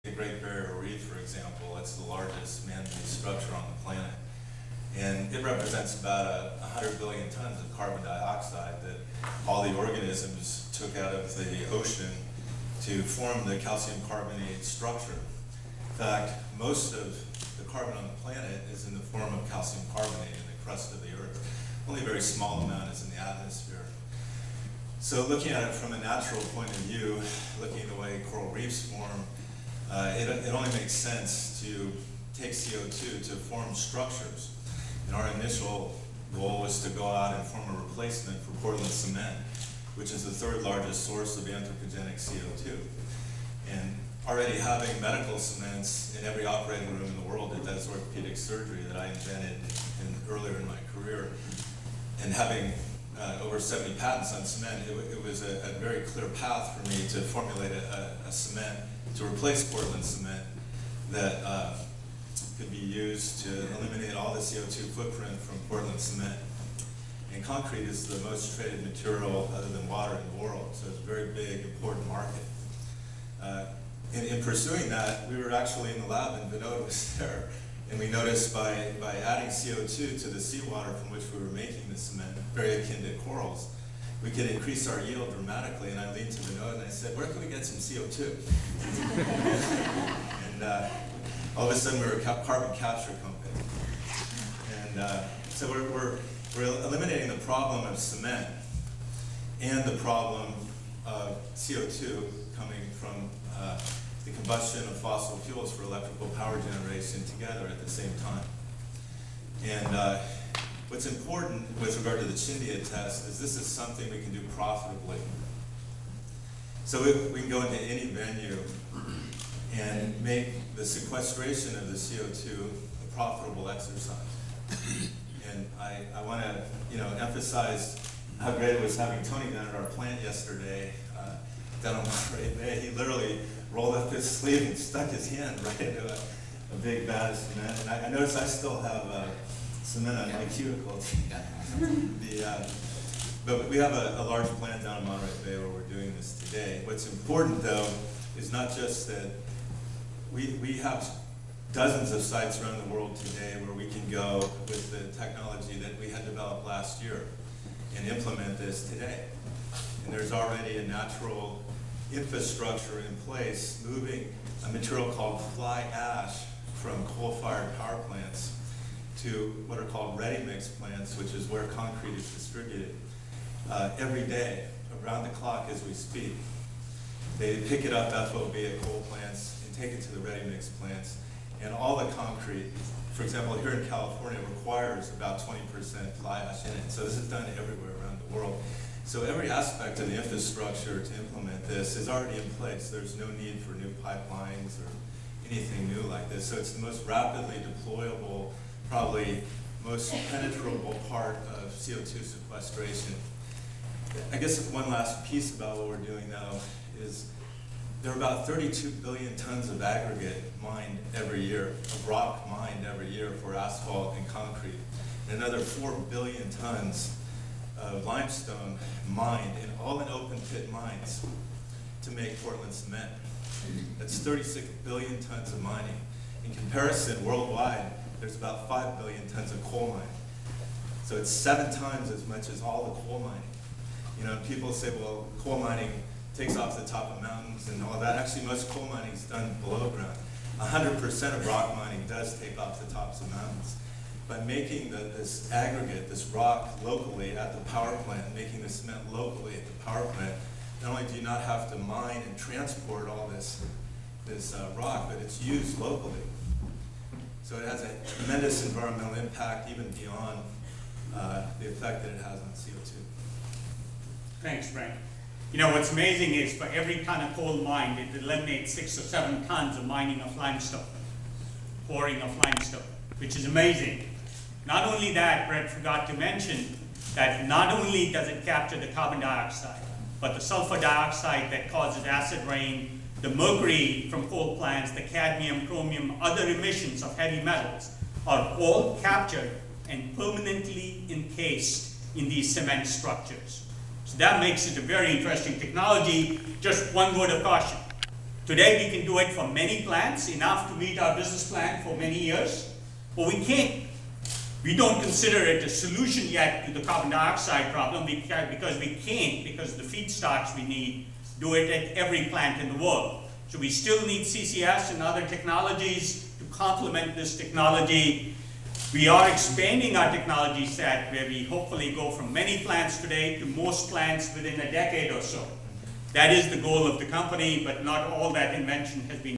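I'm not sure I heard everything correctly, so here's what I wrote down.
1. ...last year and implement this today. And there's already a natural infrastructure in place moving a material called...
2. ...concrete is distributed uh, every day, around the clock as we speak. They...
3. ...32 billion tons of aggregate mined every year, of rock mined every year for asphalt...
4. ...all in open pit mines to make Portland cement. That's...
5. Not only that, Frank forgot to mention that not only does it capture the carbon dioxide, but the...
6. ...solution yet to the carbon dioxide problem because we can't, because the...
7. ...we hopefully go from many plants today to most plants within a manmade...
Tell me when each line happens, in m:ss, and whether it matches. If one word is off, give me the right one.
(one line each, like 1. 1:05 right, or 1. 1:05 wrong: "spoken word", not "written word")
1. 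2:36 right
2. 2:51 right
3. 3:28 right
4. 3:39 right
5. 4:34 wrong: "Brent", not "Frank"
6. 5:05 right
7. 5:21 wrong: "decade", not "manmade".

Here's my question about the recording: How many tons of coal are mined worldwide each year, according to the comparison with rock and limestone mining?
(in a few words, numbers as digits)
5 billion tons.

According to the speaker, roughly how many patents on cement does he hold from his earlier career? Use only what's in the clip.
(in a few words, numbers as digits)
over 70.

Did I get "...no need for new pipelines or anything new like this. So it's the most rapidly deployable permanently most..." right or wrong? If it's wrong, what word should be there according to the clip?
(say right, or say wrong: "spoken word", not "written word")
wrong: "probably", not "permanently".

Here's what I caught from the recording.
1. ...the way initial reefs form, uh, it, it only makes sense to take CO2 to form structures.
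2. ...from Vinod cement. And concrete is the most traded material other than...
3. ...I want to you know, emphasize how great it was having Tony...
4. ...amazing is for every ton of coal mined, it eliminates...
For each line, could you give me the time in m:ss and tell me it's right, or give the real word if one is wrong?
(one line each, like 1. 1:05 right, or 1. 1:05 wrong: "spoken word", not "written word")
1. 0:27 wrong: "coral", not "initial"
2. 1:05 wrong: "Portland", not "Vinod"
3. 2:06 right
4. 4:25 right.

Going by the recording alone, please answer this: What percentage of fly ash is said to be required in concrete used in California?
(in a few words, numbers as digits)
20%.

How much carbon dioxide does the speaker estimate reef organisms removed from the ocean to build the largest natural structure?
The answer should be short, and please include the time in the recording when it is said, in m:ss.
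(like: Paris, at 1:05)
100 billion tons, at 0:06.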